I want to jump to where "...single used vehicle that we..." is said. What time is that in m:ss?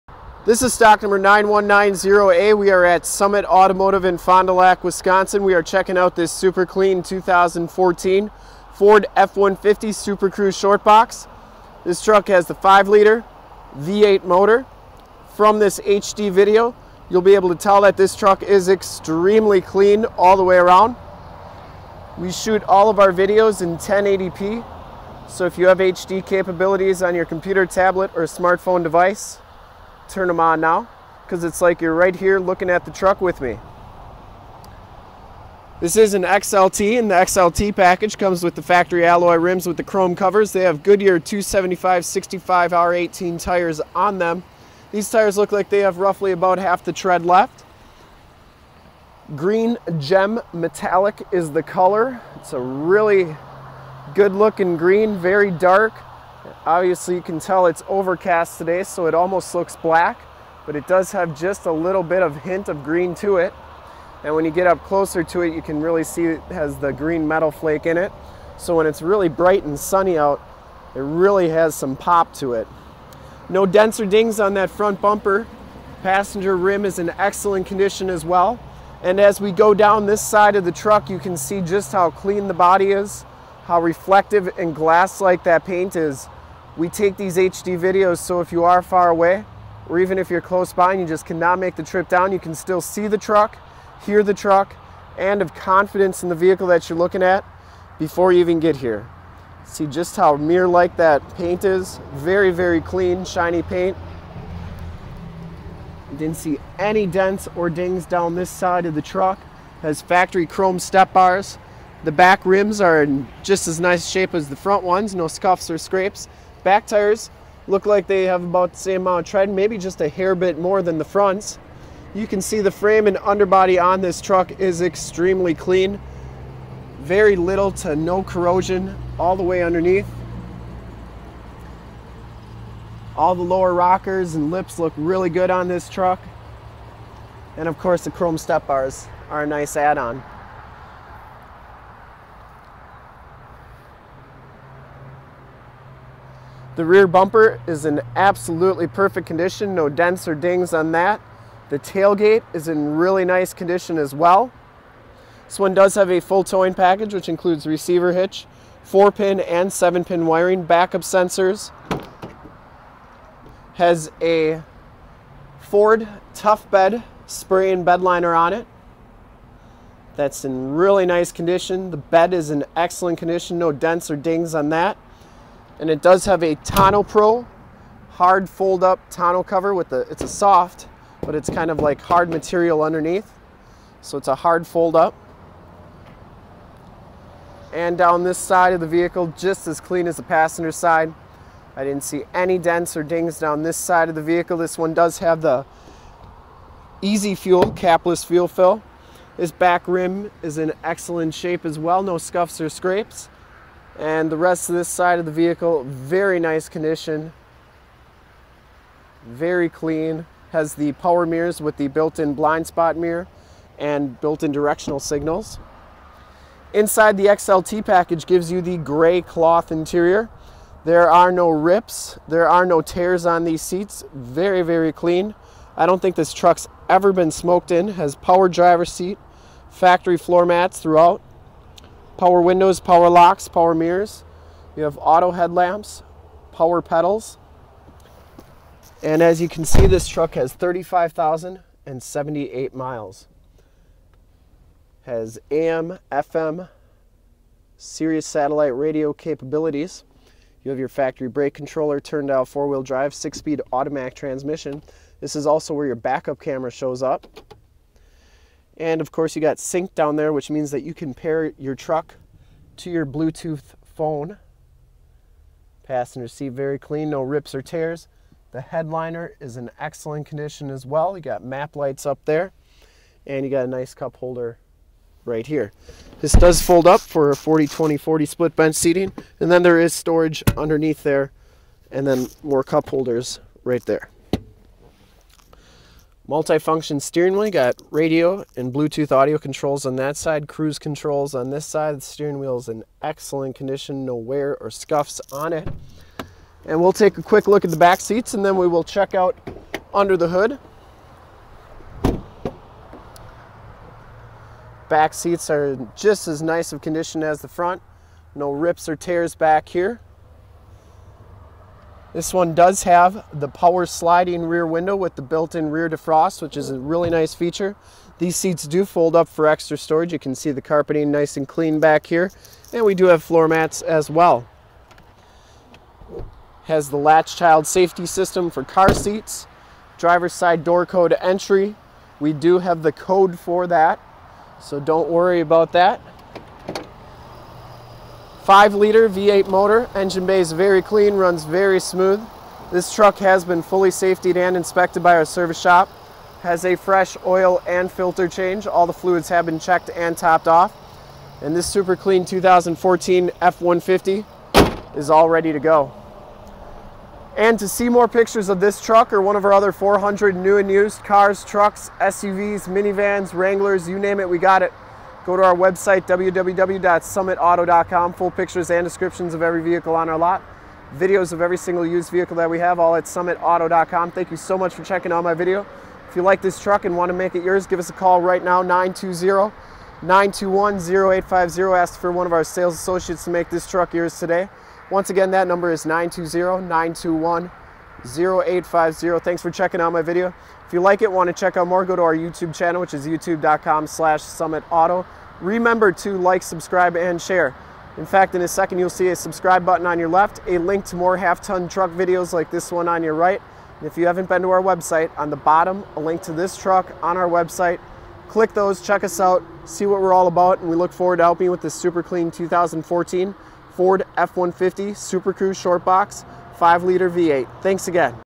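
6:11.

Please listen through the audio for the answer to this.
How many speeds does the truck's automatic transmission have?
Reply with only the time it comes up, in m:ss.
4:13.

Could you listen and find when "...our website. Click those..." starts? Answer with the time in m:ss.
6:47.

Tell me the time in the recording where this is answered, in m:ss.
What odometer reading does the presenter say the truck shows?
4:00.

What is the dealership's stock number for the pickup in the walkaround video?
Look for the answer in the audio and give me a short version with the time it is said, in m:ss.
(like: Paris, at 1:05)
9190A, at 0:01.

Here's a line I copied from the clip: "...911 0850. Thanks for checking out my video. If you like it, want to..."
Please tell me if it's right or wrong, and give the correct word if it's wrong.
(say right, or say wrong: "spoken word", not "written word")
wrong: "921", not "911".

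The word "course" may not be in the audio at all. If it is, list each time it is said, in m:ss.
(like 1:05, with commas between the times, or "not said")
2:17, 4:19.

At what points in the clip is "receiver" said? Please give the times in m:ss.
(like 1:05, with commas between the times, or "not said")
2:37.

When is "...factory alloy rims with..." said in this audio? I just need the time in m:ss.
0:38.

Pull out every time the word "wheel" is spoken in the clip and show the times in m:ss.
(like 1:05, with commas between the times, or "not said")
4:12, 4:47, 4:52.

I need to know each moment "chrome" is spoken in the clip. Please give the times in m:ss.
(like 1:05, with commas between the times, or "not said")
0:39, 1:50, 2:18.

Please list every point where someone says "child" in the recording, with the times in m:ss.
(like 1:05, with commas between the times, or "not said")
5:27.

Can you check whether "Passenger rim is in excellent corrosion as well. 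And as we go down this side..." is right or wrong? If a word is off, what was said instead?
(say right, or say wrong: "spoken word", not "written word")
wrong: "condition", not "corrosion".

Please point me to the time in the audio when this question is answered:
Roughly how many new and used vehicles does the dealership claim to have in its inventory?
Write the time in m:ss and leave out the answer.
5:59.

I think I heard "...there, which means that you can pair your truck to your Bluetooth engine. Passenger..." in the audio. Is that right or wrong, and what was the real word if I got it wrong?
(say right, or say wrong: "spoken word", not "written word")
wrong: "phone", not "engine".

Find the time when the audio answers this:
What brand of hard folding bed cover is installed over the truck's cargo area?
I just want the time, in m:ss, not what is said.
2:56.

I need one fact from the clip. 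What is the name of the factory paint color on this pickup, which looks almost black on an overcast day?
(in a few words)
Green gem metallic.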